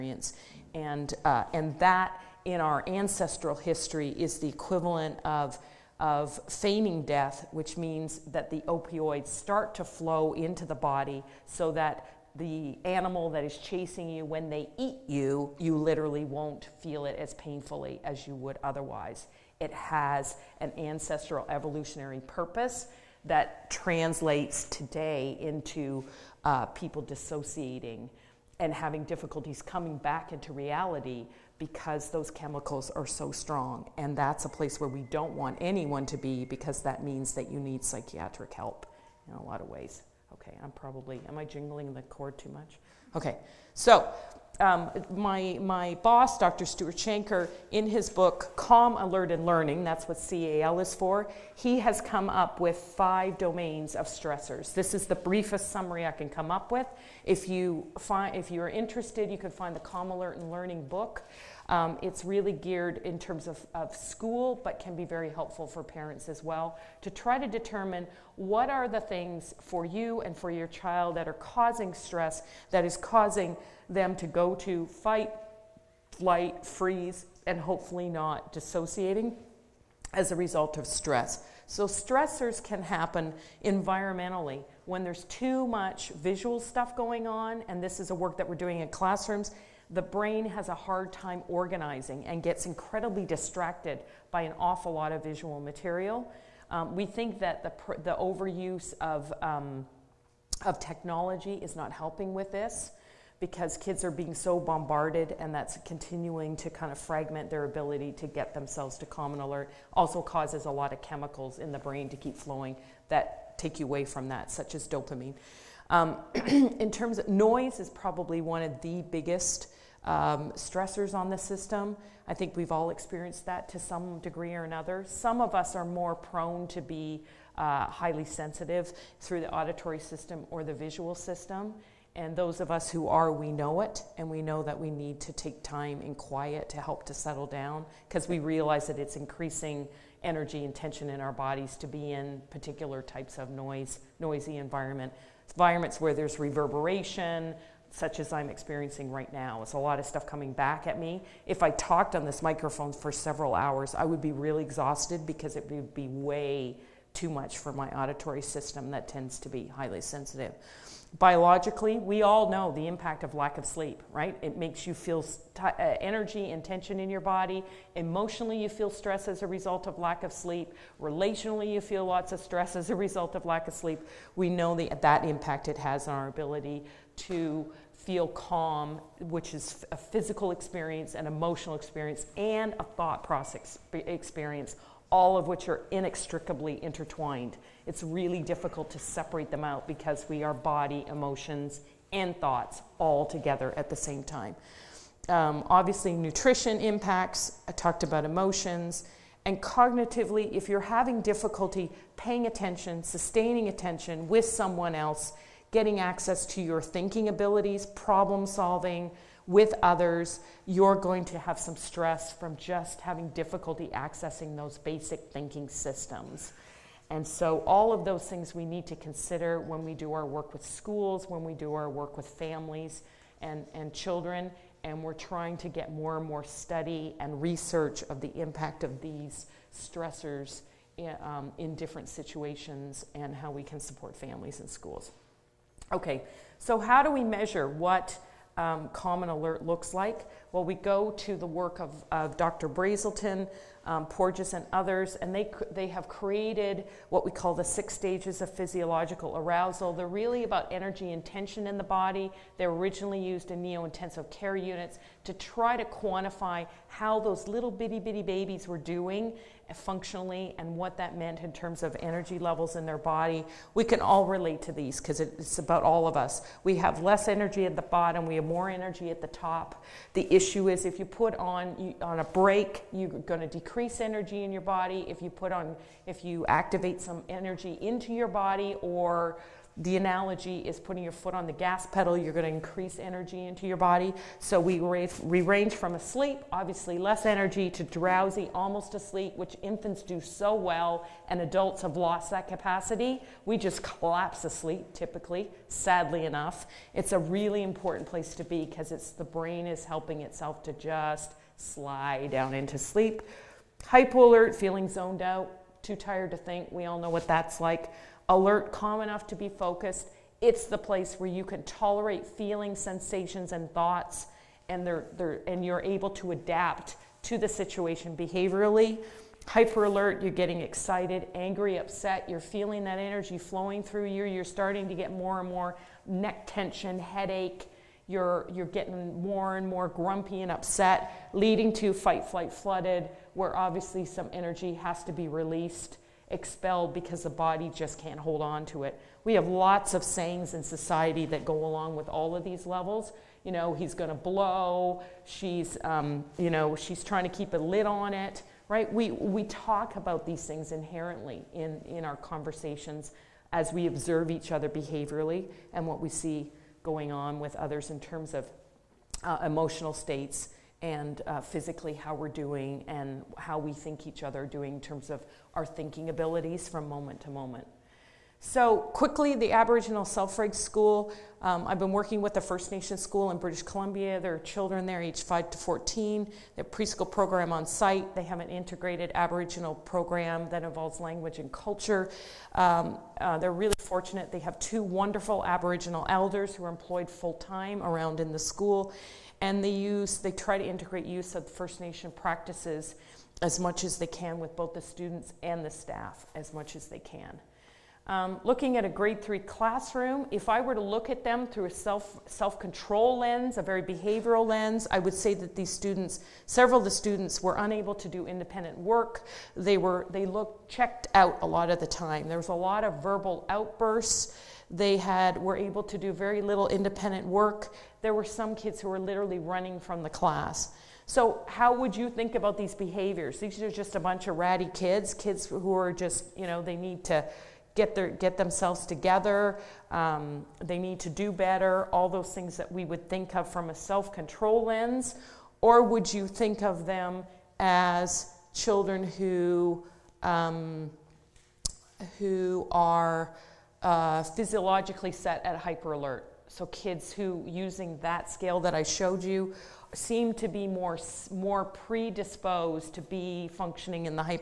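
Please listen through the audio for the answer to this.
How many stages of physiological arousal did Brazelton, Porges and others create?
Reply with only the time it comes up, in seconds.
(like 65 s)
247 s.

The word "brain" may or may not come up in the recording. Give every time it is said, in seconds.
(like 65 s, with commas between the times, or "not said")
90 s, 111 s, 299 s.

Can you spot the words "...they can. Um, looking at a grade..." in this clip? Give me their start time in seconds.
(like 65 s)
396 s.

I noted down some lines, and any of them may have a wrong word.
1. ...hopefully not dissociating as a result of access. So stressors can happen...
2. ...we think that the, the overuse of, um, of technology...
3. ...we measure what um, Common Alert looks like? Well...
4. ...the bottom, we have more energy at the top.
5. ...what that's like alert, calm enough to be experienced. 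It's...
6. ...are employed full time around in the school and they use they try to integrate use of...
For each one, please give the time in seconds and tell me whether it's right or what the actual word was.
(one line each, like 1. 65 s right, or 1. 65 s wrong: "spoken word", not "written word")
1. 77 s wrong: "stress", not "access"
2. 96 s right
3. 237 s right
4. 267 s right
5. 307 s wrong: "focused", not "experienced"
6. 386 s right.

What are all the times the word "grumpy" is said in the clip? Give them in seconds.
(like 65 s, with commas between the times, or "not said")
329 s.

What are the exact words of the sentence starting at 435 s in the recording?
Or would you think of them as children who, um, who are uh, physiologically set at hyper alert?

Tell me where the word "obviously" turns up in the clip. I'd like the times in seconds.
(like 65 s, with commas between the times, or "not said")
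195 s, 286 s, 333 s.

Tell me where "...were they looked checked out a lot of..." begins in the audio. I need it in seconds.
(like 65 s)
409 s.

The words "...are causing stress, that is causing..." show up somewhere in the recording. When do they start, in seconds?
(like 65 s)
71 s.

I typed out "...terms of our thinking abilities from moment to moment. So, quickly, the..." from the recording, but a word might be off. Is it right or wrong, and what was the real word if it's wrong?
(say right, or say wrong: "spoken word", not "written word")
right.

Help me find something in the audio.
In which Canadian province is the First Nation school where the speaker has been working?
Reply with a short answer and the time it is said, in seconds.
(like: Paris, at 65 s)
British Columbia, at 373 s.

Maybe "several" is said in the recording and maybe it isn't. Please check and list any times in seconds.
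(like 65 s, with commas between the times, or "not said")
153 s, 406 s.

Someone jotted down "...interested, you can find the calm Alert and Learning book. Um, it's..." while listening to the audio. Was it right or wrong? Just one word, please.
right.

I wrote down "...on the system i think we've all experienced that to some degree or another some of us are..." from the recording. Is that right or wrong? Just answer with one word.
right.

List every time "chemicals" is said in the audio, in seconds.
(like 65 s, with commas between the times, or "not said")
32 s, 111 s.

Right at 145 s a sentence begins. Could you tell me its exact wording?
Environments where there's reverberation, such as I'm experiencing right now.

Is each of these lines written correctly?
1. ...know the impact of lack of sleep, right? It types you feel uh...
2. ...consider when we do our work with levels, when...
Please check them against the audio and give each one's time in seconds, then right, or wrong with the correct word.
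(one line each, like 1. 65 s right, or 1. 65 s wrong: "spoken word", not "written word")
1. 162 s wrong: "makes", not "types"
2. 218 s wrong: "schools", not "levels".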